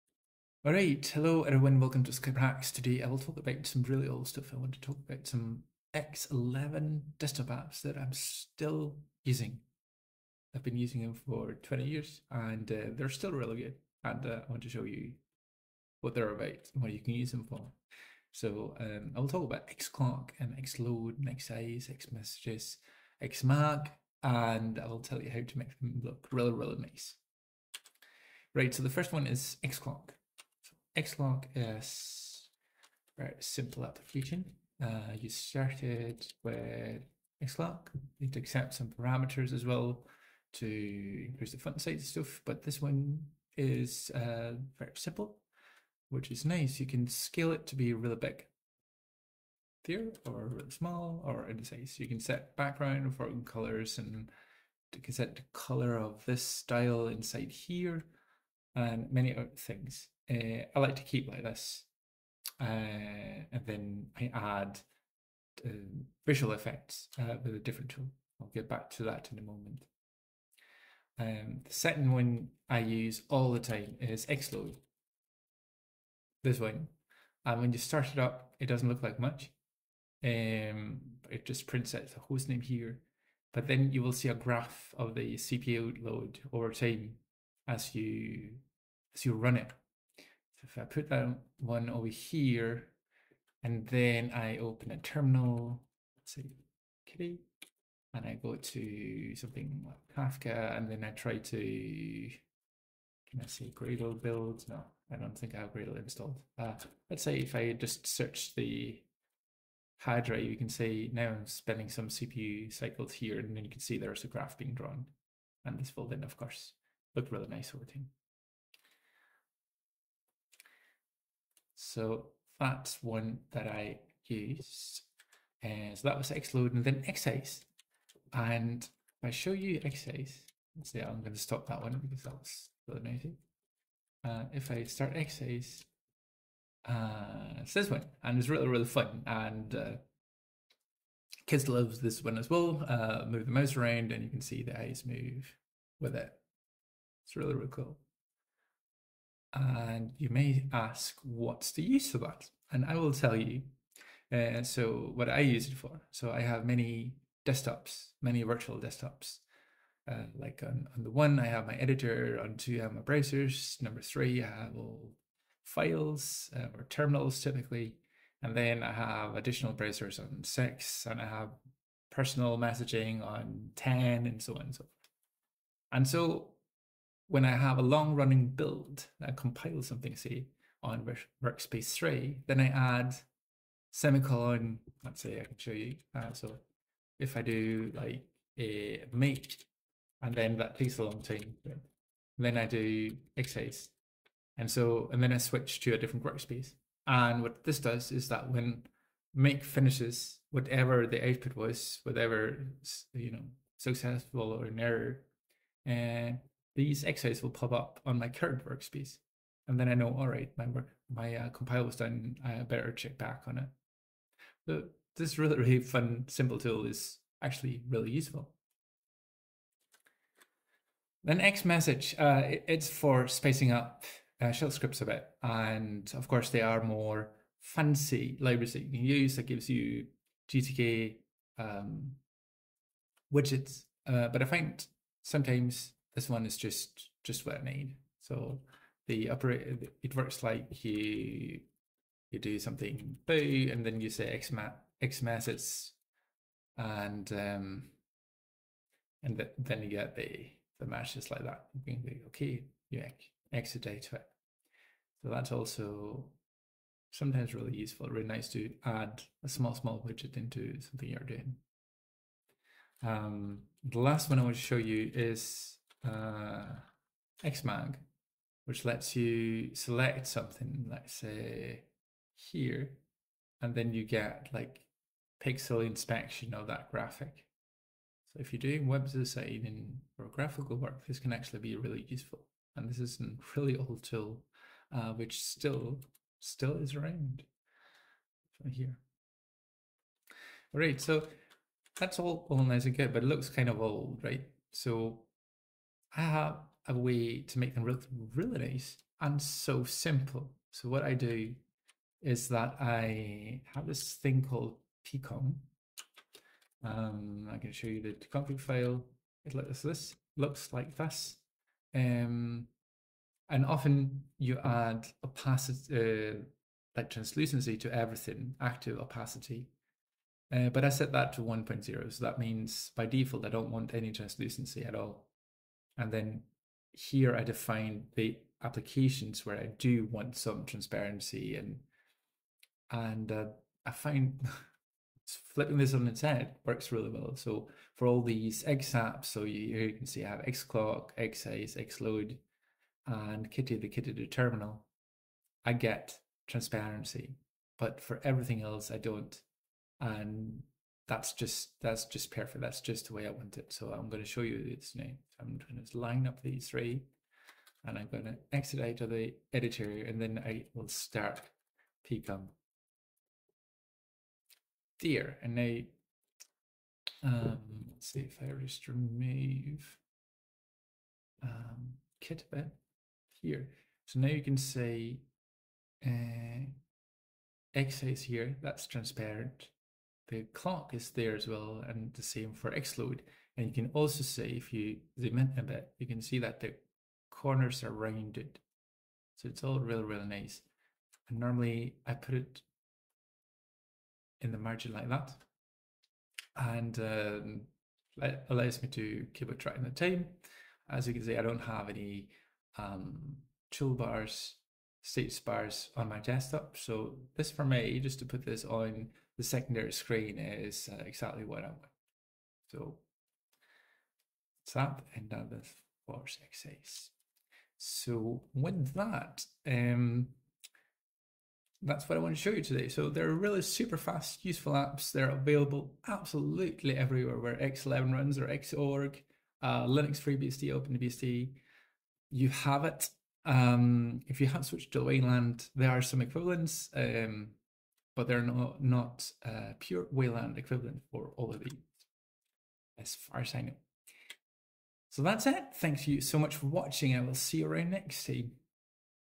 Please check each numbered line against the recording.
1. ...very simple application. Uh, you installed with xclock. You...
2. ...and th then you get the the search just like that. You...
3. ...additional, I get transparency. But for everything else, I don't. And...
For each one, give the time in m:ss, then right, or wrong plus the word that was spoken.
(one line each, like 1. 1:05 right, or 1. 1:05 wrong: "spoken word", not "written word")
1. 0:33 wrong: "started", not "installed"
2. 4:09 wrong: "match", not "search"
3. 5:44 wrong: "terminal", not "additional".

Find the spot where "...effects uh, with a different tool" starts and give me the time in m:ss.
1:06.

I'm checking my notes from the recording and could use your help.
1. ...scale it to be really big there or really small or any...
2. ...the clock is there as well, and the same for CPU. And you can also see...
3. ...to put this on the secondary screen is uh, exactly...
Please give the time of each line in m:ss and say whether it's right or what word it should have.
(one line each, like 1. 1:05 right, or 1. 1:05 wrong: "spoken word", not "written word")
1. 0:47 right
2. 6:20 wrong: "Xload", not "CPU"
3. 6:48 right.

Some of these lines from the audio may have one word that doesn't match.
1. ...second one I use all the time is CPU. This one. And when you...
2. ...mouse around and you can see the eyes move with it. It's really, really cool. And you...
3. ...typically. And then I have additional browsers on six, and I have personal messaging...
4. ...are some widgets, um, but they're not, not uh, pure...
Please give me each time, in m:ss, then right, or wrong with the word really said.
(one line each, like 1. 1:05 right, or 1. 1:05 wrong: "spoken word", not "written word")
1. 1:11 wrong: "Xload", not "CPU"
2. 2:23 right
3. 2:47 right
4. 7:15 wrong: "equivalents", not "widgets".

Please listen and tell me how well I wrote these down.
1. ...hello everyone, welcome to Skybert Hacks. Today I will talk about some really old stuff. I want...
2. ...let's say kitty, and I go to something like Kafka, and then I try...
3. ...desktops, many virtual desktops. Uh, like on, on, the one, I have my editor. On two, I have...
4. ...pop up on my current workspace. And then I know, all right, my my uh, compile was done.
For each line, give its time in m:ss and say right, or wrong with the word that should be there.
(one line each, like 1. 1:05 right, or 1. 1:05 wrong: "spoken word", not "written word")
1. 0:01 right
2. 1:36 right
3. 2:37 right
4. 3:27 right.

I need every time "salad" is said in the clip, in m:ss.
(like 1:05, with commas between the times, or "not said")
not said.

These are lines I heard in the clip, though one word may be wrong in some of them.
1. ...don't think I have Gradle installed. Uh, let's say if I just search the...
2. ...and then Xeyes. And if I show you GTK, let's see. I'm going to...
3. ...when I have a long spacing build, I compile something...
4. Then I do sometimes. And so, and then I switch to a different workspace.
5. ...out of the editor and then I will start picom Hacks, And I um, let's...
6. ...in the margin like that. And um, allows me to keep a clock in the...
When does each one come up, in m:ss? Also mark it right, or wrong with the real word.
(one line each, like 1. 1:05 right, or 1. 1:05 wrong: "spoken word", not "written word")
1. 1:45 right
2. 2:06 wrong: "Xeyes", not "GTK"
3. 2:57 wrong: "running", not "spacing"
4. 3:12 wrong: "xeyes", not "sometimes"
5. 5:58 wrong: "Here", not "Hacks"
6. 6:34 wrong: "track", not "clock".